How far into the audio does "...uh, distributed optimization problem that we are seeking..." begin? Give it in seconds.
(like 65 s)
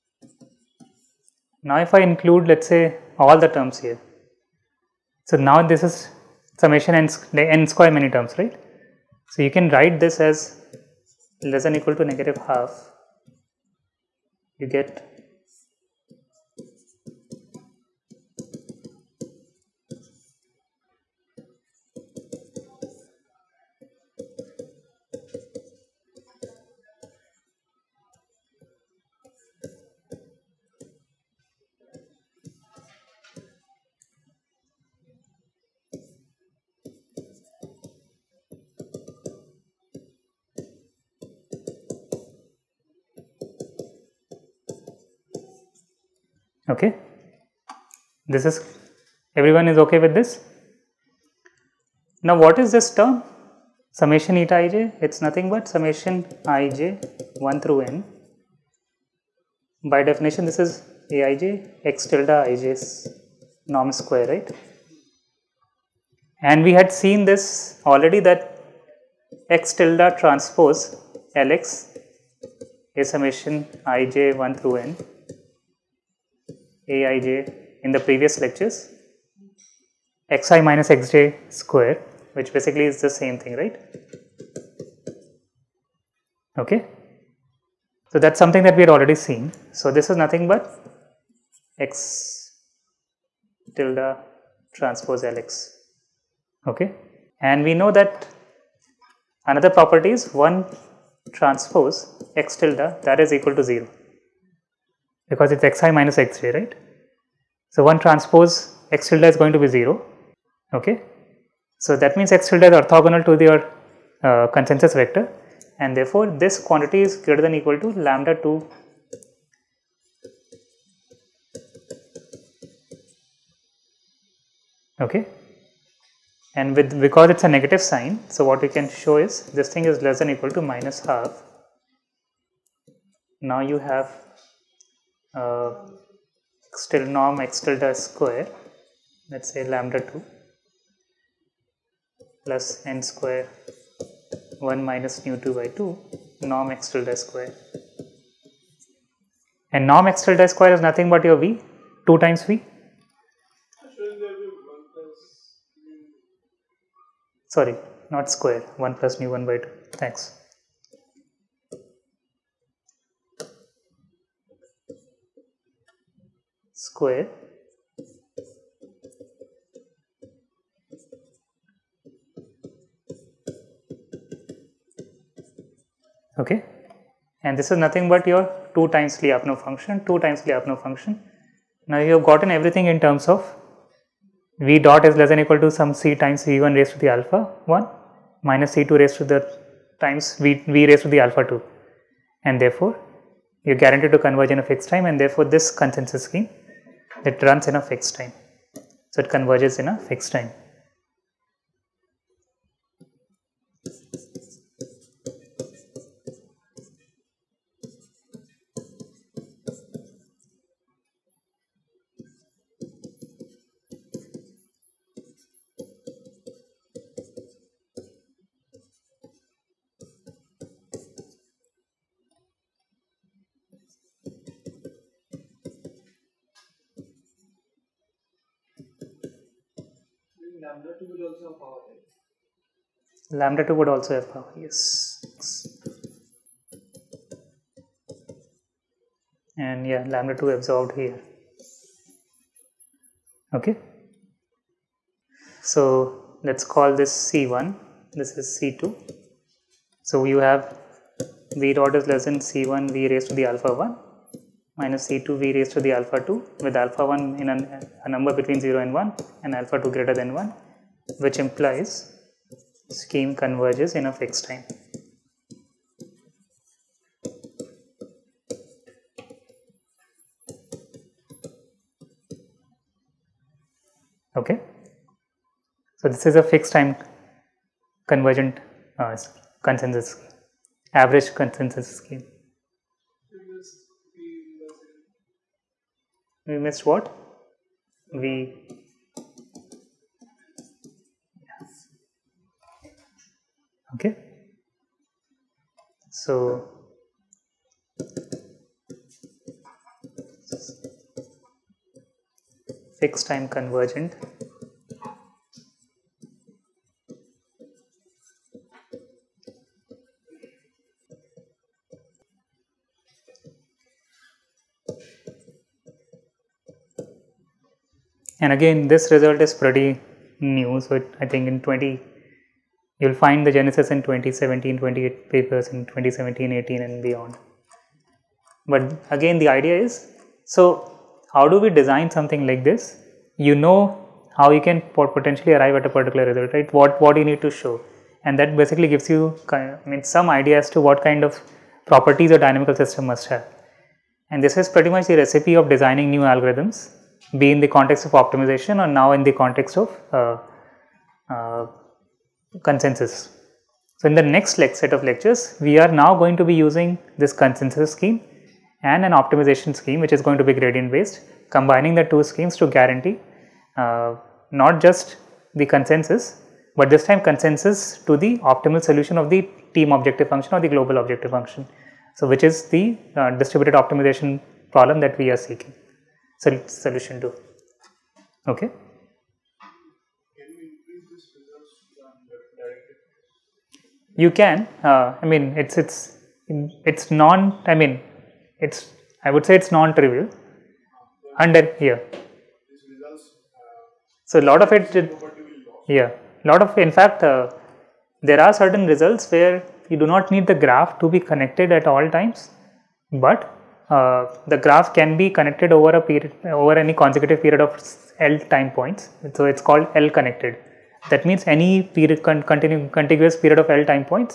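373 s.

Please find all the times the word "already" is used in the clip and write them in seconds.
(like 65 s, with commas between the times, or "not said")
67 s, 88 s.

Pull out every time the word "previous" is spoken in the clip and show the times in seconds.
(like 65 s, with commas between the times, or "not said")
78 s.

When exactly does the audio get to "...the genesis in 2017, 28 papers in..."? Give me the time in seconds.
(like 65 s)
323 s.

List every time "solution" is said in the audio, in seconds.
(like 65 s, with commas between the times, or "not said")
368 s, 376 s.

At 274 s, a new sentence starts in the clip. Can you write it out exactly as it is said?
Okay, so this is a fixed time convergent uh, consensus scheme, average consensus scheme.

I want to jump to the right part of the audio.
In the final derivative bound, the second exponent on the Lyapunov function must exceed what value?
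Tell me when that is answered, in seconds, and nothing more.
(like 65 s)
259 s.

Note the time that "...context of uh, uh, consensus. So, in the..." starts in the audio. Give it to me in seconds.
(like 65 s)
349 s.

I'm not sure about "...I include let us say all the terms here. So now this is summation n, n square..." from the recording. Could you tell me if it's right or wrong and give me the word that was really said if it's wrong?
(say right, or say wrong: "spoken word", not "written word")
right.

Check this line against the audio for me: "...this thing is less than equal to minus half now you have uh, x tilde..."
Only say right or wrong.
right.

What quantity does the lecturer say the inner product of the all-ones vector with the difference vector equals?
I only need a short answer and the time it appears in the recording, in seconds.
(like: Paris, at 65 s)
0, at 103 s.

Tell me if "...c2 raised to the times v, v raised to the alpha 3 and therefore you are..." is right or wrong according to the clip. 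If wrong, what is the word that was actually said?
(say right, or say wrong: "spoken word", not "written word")
wrong: "2", not "3".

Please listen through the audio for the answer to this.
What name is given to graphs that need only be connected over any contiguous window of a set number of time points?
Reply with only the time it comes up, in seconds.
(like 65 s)
410 s.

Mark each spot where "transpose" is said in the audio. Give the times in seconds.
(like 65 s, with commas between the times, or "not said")
70 s, 94 s, 101 s, 108 s.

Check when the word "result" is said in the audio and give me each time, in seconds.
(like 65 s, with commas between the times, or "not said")
319 s, 336 s, 398 s.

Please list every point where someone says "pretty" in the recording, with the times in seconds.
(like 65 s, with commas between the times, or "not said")
319 s, 344 s.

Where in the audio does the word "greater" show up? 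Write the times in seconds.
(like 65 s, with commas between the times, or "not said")
117 s, 259 s.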